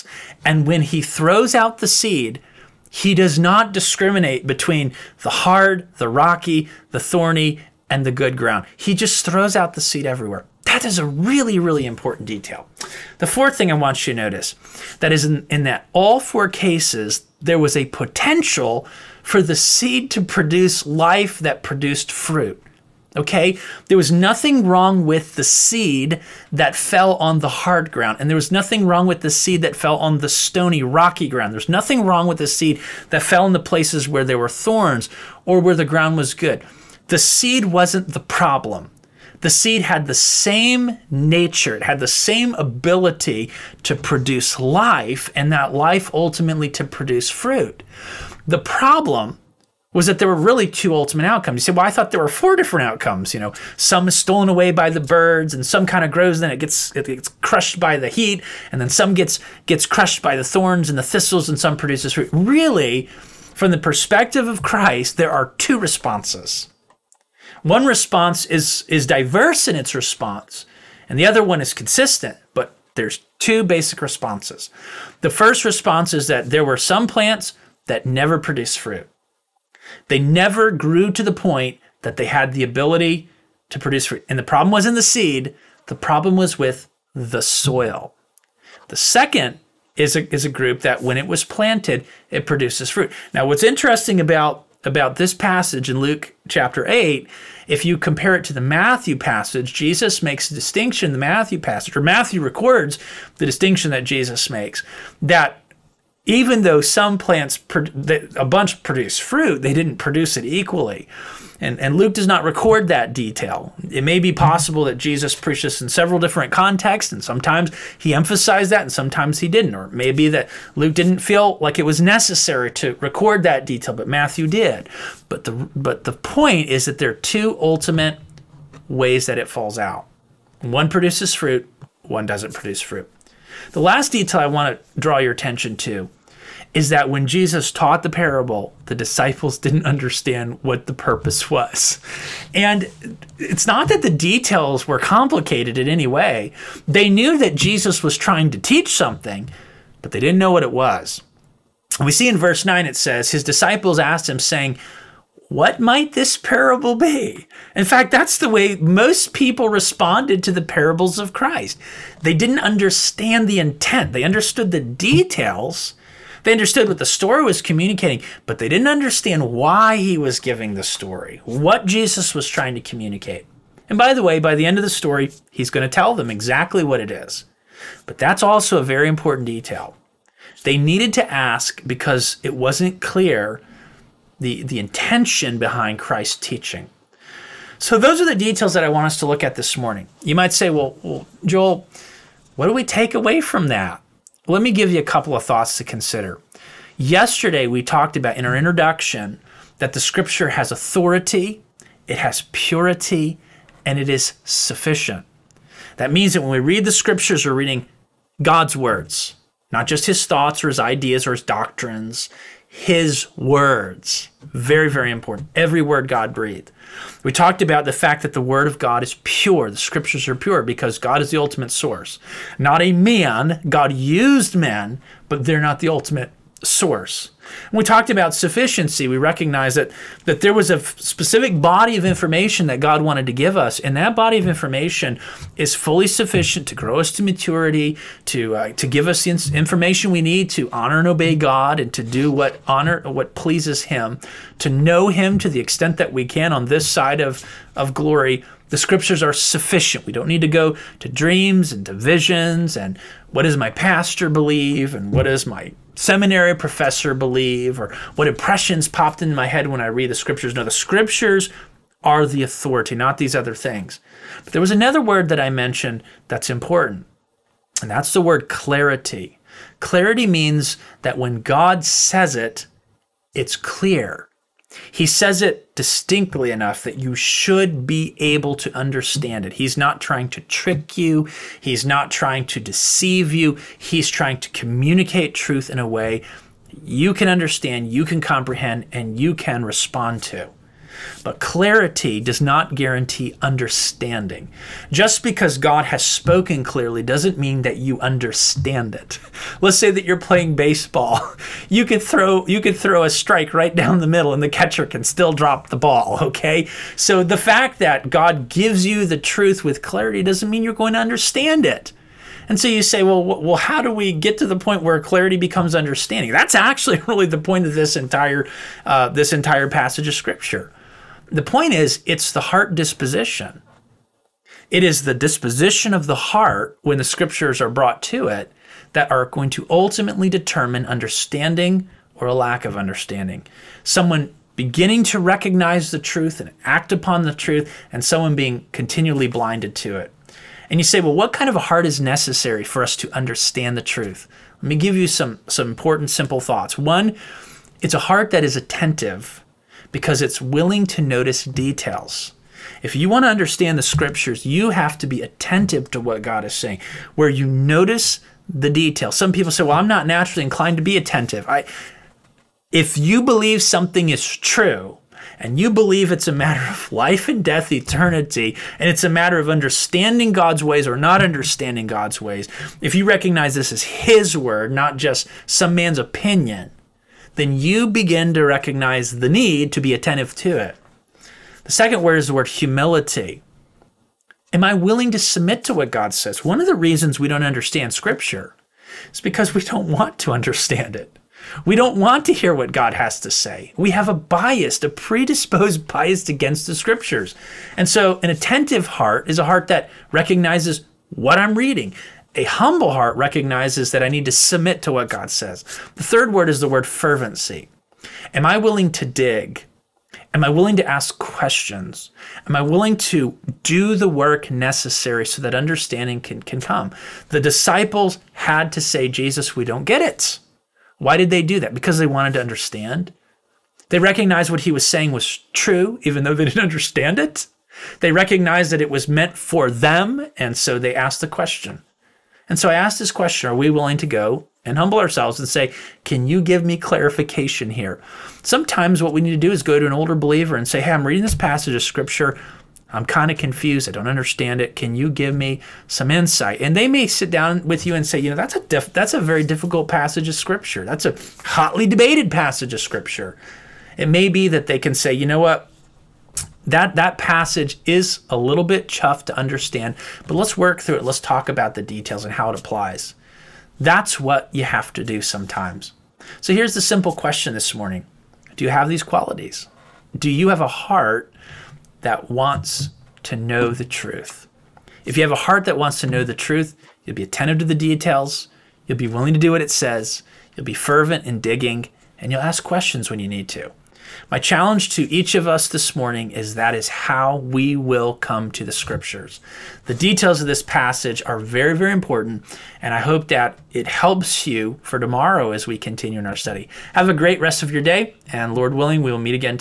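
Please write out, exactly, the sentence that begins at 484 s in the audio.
My challenge to each of us this morning is that is how we will come to the scriptures.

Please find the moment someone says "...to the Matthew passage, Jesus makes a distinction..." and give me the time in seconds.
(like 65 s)
98 s.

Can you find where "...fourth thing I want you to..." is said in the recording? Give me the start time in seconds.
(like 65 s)
13 s.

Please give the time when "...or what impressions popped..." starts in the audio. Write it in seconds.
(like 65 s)
257 s.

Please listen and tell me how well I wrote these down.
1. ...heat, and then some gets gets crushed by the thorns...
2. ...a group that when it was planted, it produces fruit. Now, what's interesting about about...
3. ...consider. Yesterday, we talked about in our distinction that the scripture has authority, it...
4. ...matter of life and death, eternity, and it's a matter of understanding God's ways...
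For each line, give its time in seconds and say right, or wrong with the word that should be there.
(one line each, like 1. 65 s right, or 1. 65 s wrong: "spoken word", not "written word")
1. 58 s right
2. 90 s right
3. 195 s wrong: "introduction", not "distinction"
4. 366 s right.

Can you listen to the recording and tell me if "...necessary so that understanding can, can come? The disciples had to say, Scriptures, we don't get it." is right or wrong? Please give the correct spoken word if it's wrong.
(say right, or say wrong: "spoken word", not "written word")
wrong: "Jesus", not "Scriptures".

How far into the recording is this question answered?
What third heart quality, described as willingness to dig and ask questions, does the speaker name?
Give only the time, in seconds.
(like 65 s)
406 s.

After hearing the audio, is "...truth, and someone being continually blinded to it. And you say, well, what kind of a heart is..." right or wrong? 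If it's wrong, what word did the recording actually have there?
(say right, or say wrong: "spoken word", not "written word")
right.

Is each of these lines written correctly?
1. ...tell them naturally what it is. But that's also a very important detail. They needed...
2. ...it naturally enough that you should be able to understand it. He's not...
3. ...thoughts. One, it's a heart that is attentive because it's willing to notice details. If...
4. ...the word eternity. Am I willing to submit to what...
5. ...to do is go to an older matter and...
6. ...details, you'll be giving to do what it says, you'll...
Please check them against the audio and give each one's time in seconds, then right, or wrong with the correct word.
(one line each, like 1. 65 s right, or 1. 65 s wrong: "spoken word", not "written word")
1. 175 s wrong: "exactly", not "naturally"
2. 275 s wrong: "distinctly", not "naturally"
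3. 346 s right
4. 382 s wrong: "humility", not "eternity"
5. 439 s wrong: "believer", not "matter"
6. 477 s wrong: "willing", not "giving".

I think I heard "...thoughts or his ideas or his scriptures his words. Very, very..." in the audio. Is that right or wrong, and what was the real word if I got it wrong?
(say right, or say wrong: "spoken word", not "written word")
wrong: "doctrines", not "scriptures".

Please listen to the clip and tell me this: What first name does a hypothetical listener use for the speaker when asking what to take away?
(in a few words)
Joel.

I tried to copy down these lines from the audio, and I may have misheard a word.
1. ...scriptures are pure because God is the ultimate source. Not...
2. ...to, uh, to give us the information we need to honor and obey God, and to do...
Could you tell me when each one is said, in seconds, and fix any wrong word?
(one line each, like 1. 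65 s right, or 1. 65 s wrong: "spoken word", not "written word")
1. 219 s right
2. 238 s right.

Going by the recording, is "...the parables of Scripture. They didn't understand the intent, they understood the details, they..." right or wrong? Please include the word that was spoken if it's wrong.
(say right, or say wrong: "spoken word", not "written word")
wrong: "Christ", not "Scripture".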